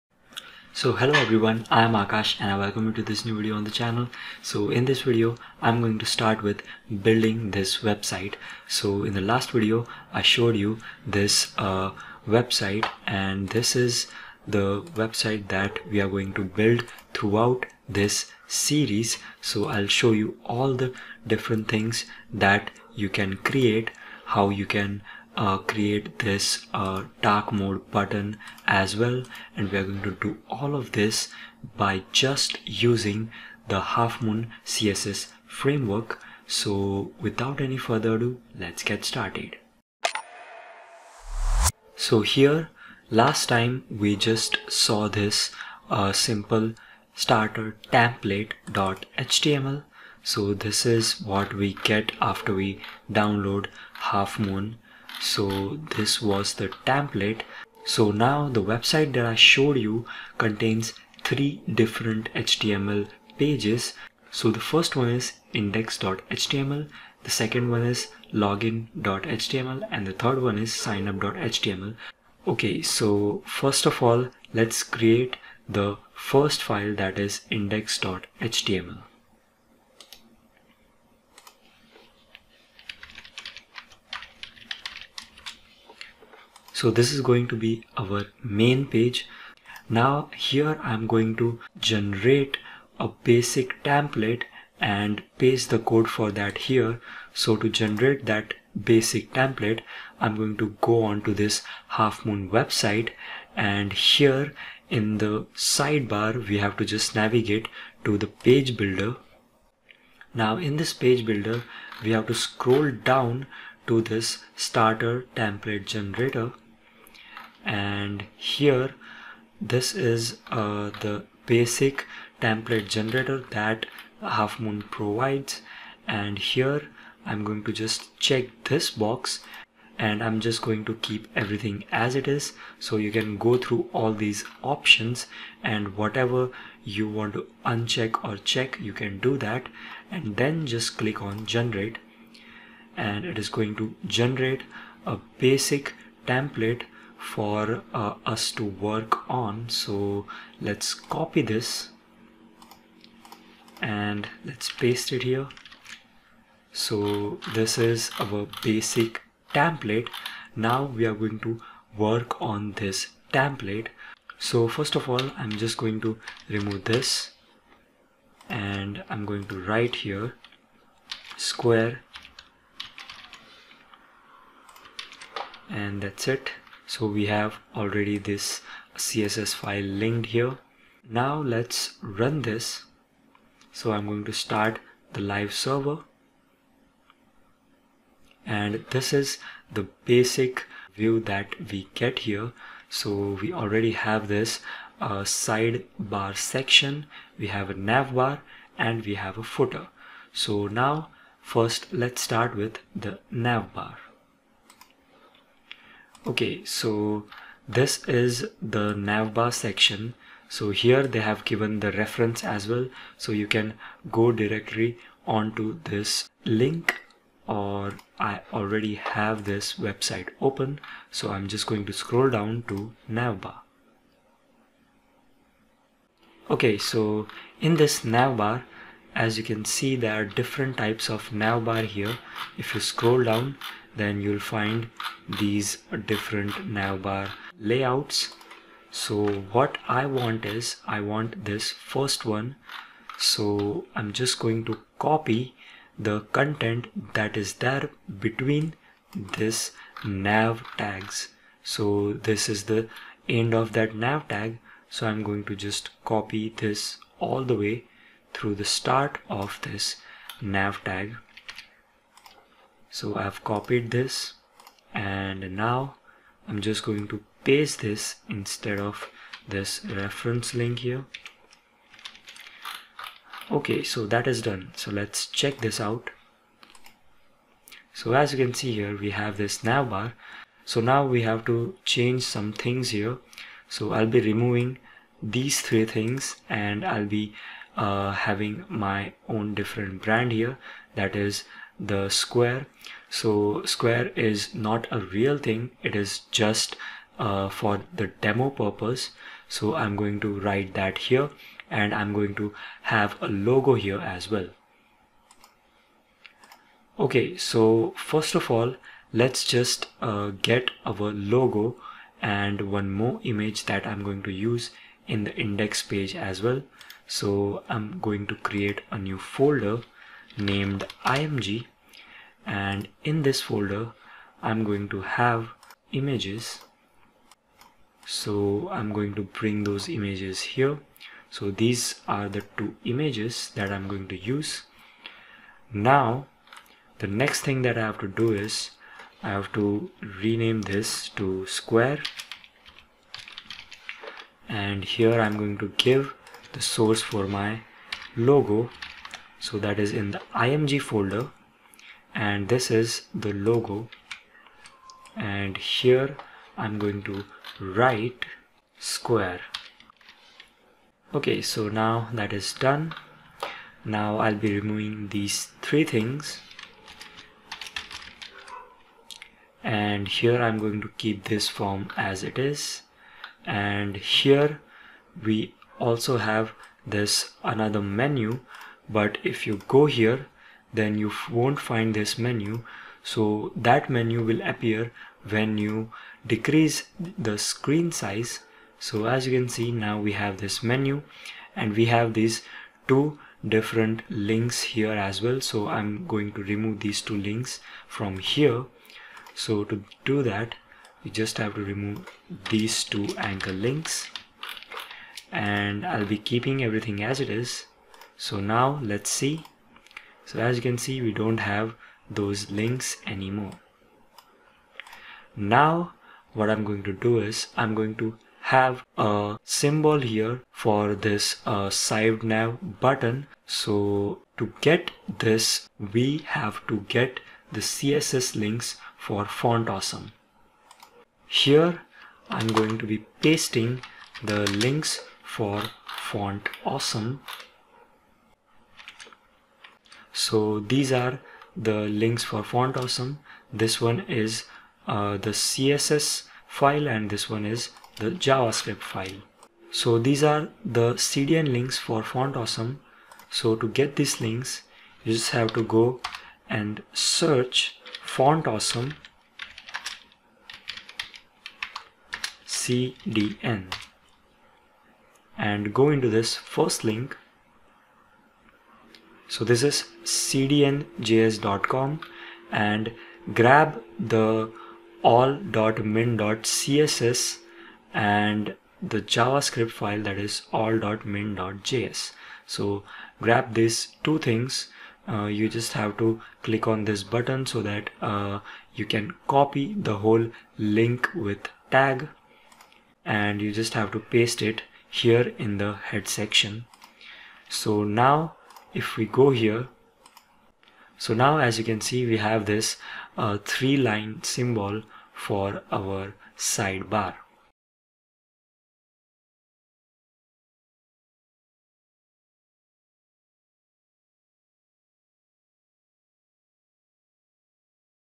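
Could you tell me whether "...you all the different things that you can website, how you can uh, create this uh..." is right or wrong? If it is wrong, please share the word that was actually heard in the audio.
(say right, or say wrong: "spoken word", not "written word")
wrong: "create", not "website".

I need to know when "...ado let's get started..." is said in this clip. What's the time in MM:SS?
00:38.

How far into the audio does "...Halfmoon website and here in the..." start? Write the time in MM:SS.
01:41.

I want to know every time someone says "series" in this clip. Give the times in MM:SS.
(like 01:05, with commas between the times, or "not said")
00:18.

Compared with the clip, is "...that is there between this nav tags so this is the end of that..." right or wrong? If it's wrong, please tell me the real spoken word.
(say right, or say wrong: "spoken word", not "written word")
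right.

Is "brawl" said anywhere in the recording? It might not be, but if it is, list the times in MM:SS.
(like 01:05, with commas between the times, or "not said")
not said.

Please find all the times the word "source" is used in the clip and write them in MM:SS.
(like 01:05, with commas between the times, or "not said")
05:46.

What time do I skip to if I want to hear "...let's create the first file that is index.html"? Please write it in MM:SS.
01:14.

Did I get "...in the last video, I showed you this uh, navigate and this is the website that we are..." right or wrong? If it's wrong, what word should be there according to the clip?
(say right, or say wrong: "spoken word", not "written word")
wrong: "website", not "navigate".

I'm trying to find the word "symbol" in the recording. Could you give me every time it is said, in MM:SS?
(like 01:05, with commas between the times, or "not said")
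06:59, 08:24.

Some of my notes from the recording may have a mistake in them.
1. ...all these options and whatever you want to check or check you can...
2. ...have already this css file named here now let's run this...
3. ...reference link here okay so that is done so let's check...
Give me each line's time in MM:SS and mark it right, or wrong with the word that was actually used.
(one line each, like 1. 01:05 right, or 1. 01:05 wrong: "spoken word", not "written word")
1. 02:13 wrong: "uncheck", not "check"
2. 02:57 wrong: "linked", not "named"
3. 04:29 right.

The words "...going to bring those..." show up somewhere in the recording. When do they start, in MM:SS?
05:28.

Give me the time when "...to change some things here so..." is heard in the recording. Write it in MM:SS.
04:41.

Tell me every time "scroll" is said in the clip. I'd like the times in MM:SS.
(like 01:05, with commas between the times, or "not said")
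01:52, 03:41, 03:52.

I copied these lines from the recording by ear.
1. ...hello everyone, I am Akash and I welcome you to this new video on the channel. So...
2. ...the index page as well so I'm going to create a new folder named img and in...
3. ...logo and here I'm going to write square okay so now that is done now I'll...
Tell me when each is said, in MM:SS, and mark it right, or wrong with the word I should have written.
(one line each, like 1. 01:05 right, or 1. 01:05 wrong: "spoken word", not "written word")
1. 00:00 right
2. 05:15 right
3. 05:53 right.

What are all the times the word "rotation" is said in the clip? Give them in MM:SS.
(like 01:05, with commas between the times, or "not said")
not said.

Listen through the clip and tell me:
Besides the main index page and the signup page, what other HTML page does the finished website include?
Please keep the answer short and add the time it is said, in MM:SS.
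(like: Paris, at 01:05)
login.html, at 01:08.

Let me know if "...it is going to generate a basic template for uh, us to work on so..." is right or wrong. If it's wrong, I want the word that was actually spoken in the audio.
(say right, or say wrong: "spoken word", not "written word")
right.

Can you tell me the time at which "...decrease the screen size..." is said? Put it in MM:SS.
06:26.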